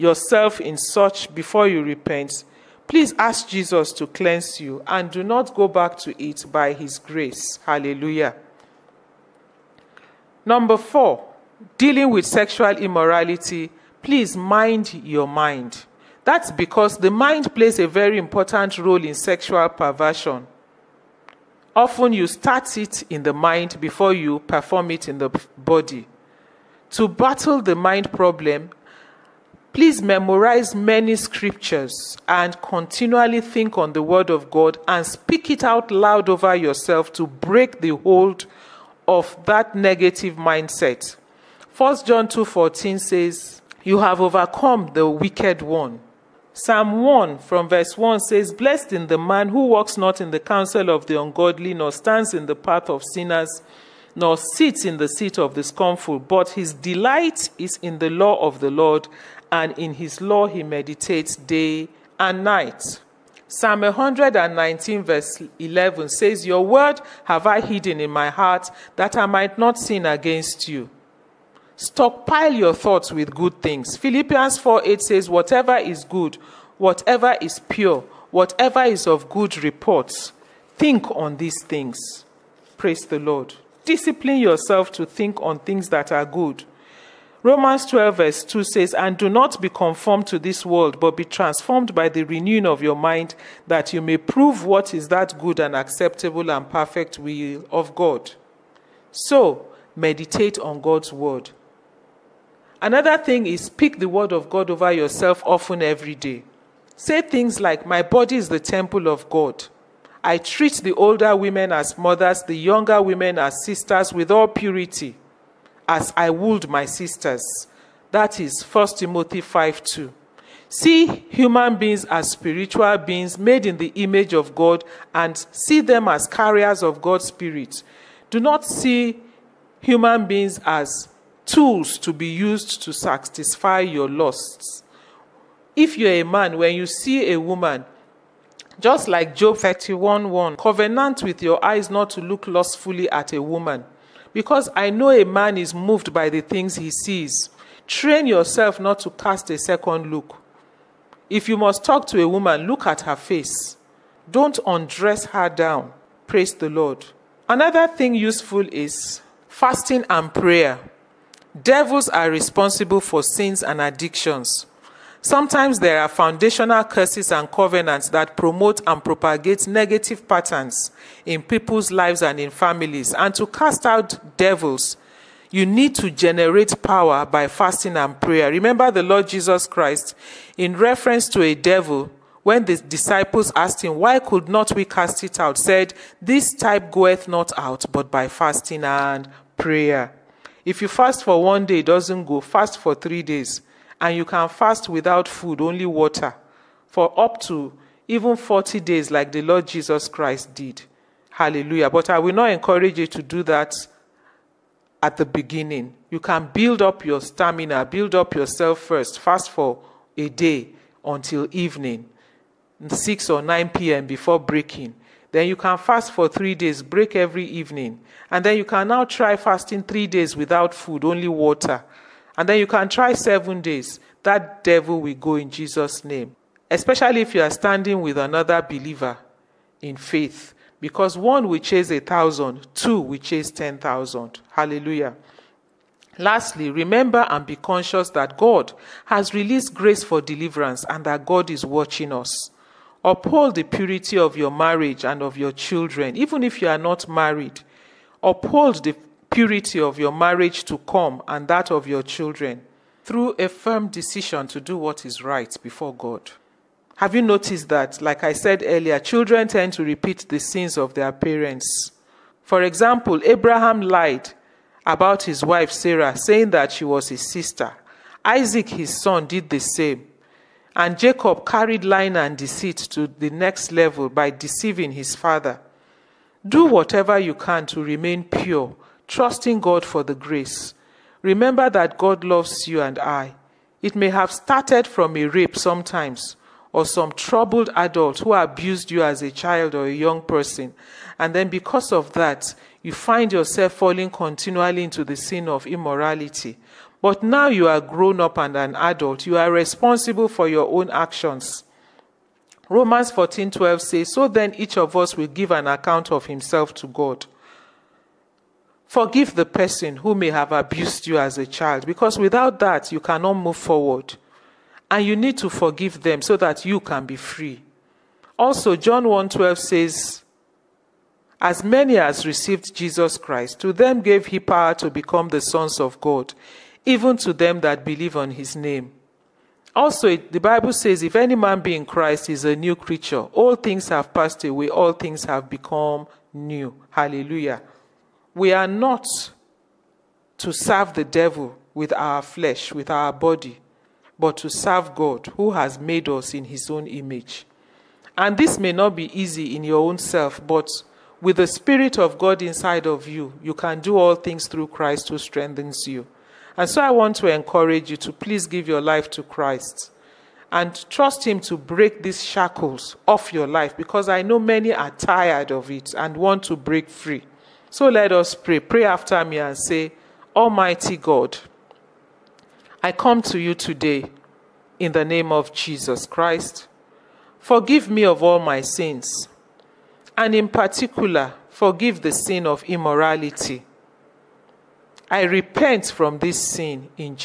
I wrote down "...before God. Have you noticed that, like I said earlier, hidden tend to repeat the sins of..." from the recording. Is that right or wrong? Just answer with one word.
wrong.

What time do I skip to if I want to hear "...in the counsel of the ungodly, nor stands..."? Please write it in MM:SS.
00:50.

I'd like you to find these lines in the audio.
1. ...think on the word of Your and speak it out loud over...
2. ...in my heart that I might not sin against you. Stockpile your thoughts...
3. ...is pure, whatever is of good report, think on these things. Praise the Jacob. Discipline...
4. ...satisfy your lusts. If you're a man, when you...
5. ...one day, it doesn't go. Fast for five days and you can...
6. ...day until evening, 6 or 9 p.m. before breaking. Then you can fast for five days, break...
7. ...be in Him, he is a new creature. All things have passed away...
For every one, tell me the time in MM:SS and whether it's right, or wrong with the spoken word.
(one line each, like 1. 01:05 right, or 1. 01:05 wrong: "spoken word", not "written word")
1. 00:33 wrong: "God", not "Your"
2. 01:08 right
3. 01:17 wrong: "Lord", not "Jacob"
4. 02:12 right
5. 03:11 wrong: "three", not "five"
6. 03:30 wrong: "three", not "five"
7. 05:31 wrong: "Christ", not "Him".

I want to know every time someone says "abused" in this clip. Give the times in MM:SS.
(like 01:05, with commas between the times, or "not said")
04:48, 05:10.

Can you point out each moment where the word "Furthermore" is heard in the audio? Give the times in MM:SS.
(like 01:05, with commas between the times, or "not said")
not said.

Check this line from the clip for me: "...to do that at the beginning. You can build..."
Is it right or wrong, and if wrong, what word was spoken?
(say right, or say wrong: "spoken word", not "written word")
right.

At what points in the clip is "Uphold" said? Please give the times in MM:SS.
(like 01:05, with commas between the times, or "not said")
04:03, 04:08.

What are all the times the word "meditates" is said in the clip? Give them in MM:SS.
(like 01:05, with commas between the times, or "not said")
01:00, 01:39.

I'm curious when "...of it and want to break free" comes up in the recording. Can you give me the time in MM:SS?
06:05.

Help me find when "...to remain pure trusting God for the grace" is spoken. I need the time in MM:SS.
04:37.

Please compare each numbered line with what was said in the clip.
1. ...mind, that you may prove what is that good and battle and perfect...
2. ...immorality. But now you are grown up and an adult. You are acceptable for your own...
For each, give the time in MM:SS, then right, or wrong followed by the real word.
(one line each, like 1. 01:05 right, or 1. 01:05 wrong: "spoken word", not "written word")
1. 01:32 wrong: "acceptable", not "battle"
2. 04:55 wrong: "responsible", not "acceptable".